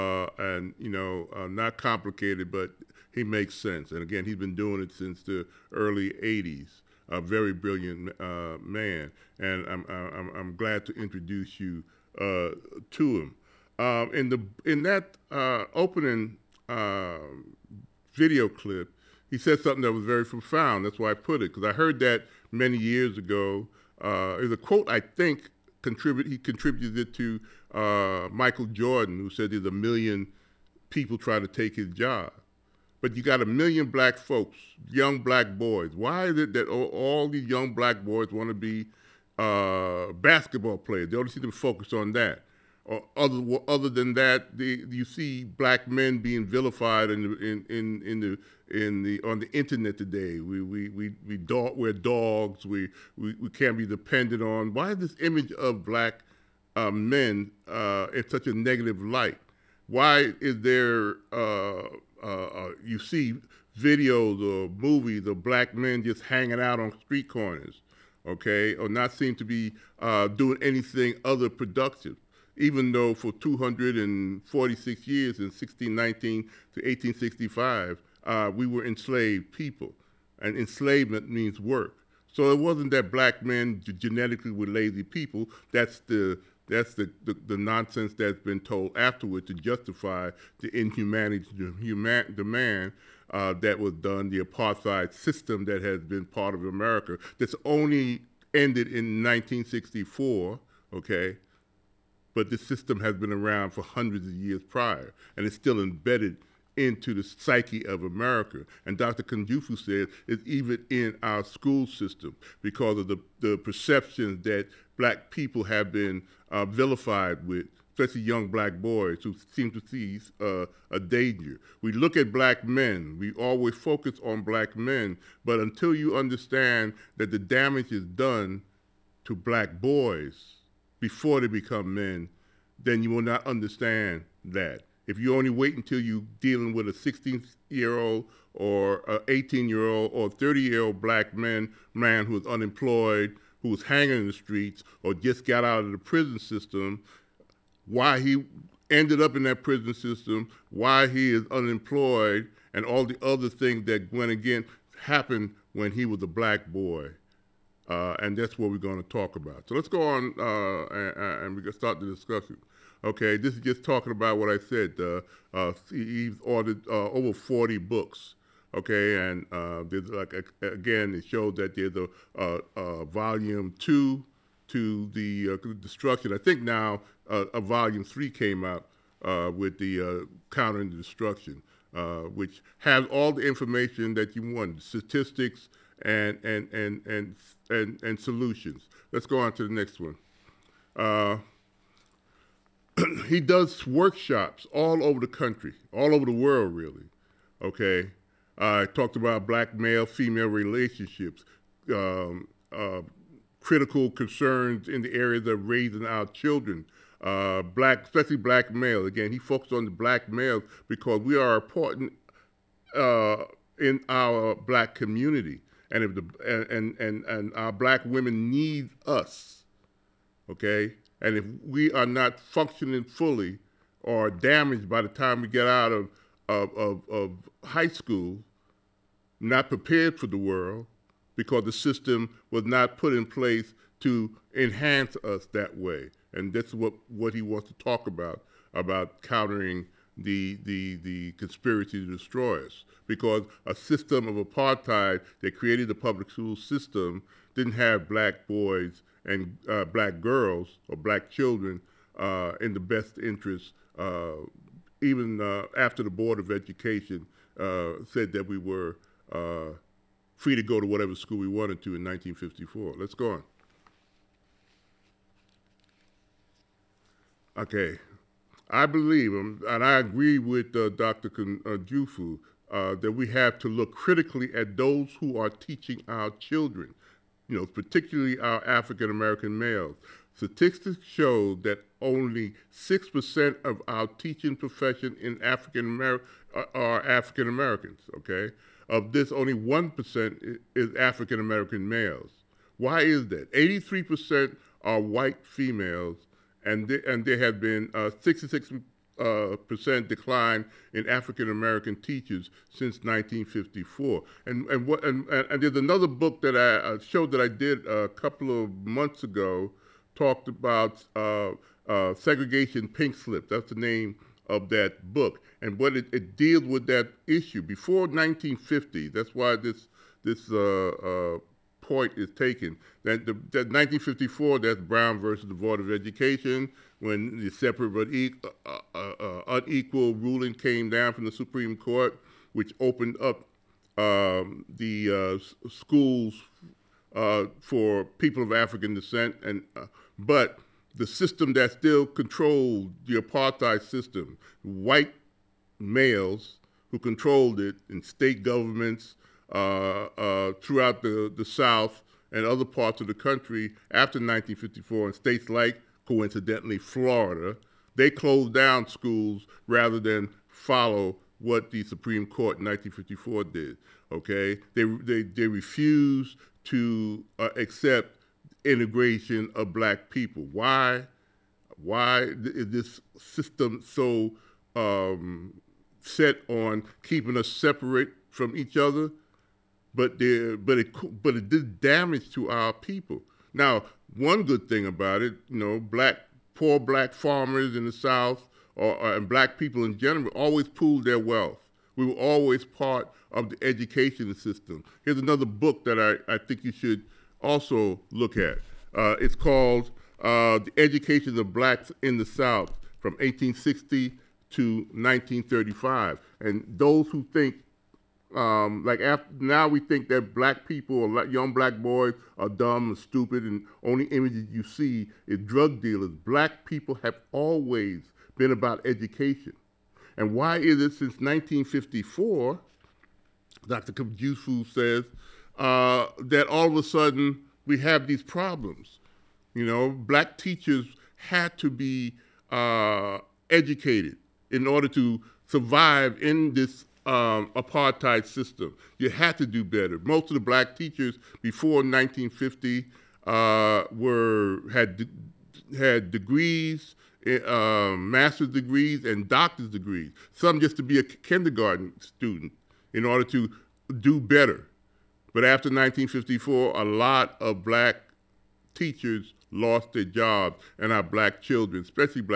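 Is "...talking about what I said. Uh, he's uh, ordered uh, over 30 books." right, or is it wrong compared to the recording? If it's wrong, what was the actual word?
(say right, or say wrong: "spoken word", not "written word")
wrong: "40", not "30".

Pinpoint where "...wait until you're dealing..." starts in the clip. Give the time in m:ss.
2:15.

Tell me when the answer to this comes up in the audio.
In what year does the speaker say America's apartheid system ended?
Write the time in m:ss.
1:39.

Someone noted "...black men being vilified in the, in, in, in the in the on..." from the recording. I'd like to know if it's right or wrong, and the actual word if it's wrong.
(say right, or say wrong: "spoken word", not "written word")
right.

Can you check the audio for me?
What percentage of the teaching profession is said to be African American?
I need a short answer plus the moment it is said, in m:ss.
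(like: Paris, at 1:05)
6%, at 4:42.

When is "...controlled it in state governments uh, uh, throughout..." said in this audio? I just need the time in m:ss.
5:46.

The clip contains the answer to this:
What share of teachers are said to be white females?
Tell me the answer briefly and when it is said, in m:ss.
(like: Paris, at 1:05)
83%, at 4:53.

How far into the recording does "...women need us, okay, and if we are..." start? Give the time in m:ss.
3:38.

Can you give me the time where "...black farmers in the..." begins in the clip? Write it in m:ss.
6:26.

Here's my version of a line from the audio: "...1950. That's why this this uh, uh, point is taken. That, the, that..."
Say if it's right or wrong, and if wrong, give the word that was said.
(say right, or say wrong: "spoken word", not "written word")
right.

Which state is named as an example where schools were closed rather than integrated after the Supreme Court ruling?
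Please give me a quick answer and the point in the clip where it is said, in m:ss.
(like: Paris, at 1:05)
Florida, at 5:56.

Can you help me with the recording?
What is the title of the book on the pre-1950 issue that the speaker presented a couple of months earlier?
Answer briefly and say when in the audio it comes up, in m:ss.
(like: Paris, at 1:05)
Segregation pink slip, at 5:12.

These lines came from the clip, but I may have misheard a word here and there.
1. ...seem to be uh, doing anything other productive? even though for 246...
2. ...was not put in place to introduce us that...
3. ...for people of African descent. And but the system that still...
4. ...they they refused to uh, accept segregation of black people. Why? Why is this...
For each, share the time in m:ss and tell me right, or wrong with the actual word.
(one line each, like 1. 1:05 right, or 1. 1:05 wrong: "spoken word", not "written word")
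1. 1:09 right
2. 3:52 wrong: "enhance", not "introduce"
3. 5:37 right
4. 6:04 wrong: "integration", not "segregation".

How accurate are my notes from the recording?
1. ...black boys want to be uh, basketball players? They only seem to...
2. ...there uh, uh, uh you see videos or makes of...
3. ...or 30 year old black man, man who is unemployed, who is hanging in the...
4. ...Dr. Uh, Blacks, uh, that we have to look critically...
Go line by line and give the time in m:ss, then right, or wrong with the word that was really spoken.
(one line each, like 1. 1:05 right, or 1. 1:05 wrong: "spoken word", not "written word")
1. 0:37 right
2. 1:00 wrong: "movies", not "makes"
3. 2:20 right
4. 4:30 wrong: "Jufu", not "Blacks".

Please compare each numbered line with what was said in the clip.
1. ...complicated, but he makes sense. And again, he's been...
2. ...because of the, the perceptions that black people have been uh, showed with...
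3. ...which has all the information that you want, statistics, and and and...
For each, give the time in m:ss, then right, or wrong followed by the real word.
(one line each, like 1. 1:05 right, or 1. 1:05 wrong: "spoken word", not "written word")
1. 0:01 right
2. 1:52 wrong: "vilified", not "showed"
3. 3:02 right.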